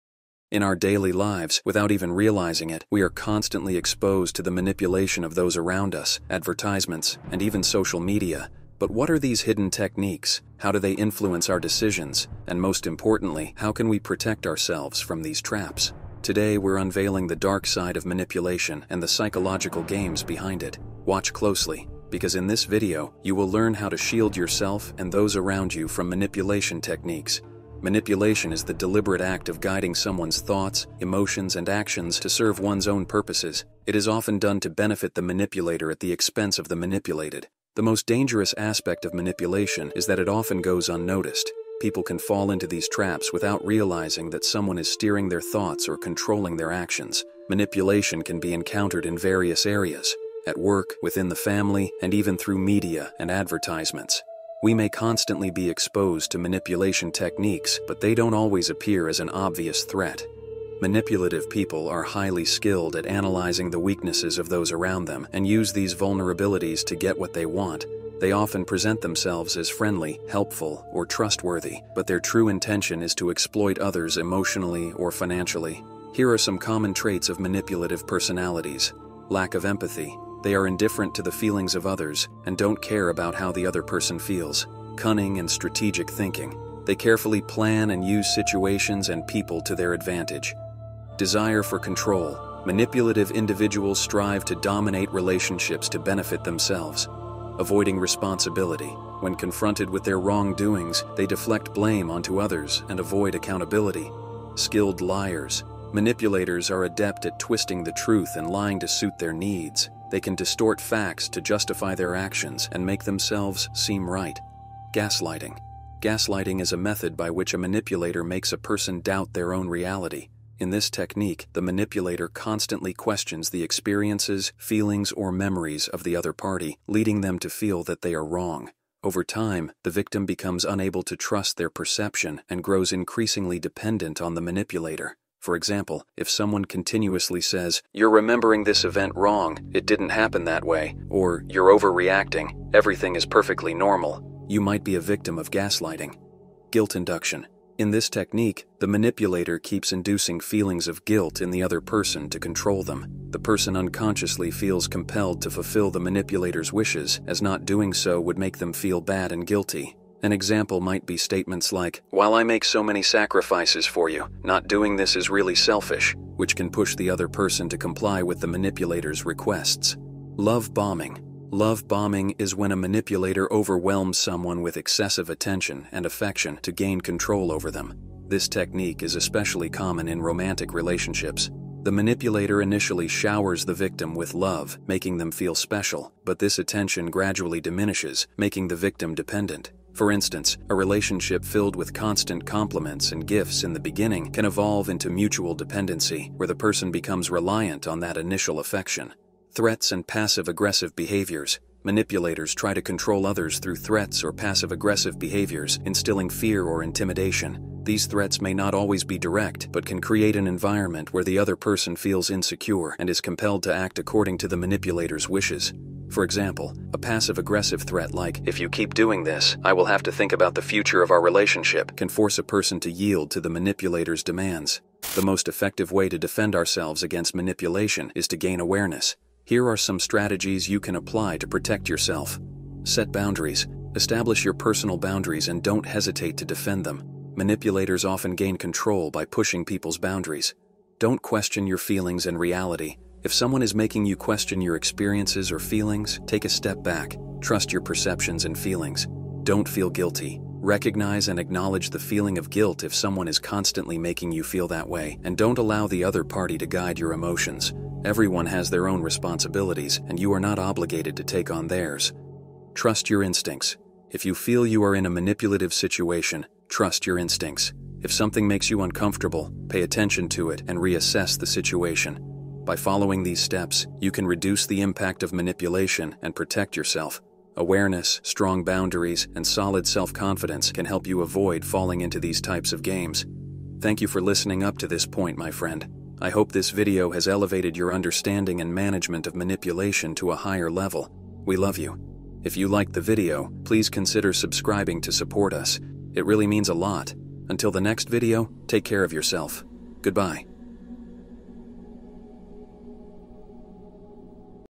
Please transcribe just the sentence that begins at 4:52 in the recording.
If you liked the video, please consider subscribing to support us.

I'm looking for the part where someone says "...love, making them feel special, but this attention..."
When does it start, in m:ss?
3:04.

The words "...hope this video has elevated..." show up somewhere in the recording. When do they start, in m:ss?
4:46.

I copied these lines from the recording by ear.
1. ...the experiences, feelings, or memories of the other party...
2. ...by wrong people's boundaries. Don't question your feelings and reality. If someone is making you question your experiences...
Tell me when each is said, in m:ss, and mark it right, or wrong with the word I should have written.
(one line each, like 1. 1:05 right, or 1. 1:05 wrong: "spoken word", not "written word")
1. 2:03 right
2. 3:59 wrong: "pushing", not "wrong".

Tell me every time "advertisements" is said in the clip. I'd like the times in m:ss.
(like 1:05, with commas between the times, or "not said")
0:06, 0:53.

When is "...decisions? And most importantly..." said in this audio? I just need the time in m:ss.
0:11.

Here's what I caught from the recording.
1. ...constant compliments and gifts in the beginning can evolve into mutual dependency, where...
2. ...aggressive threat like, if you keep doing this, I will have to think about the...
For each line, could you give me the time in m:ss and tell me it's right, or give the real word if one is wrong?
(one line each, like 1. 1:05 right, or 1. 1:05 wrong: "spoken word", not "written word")
1. 3:11 right
2. 3:37 right.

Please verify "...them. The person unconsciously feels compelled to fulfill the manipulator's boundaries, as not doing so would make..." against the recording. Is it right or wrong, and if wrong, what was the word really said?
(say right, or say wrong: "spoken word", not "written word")
wrong: "wishes", not "boundaries".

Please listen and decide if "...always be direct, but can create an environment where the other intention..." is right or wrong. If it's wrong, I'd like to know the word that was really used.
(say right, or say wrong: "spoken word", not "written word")
wrong: "person", not "intention".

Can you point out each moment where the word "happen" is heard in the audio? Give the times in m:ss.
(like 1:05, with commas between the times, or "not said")
2:20.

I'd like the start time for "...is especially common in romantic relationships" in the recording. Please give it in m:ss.
2:59.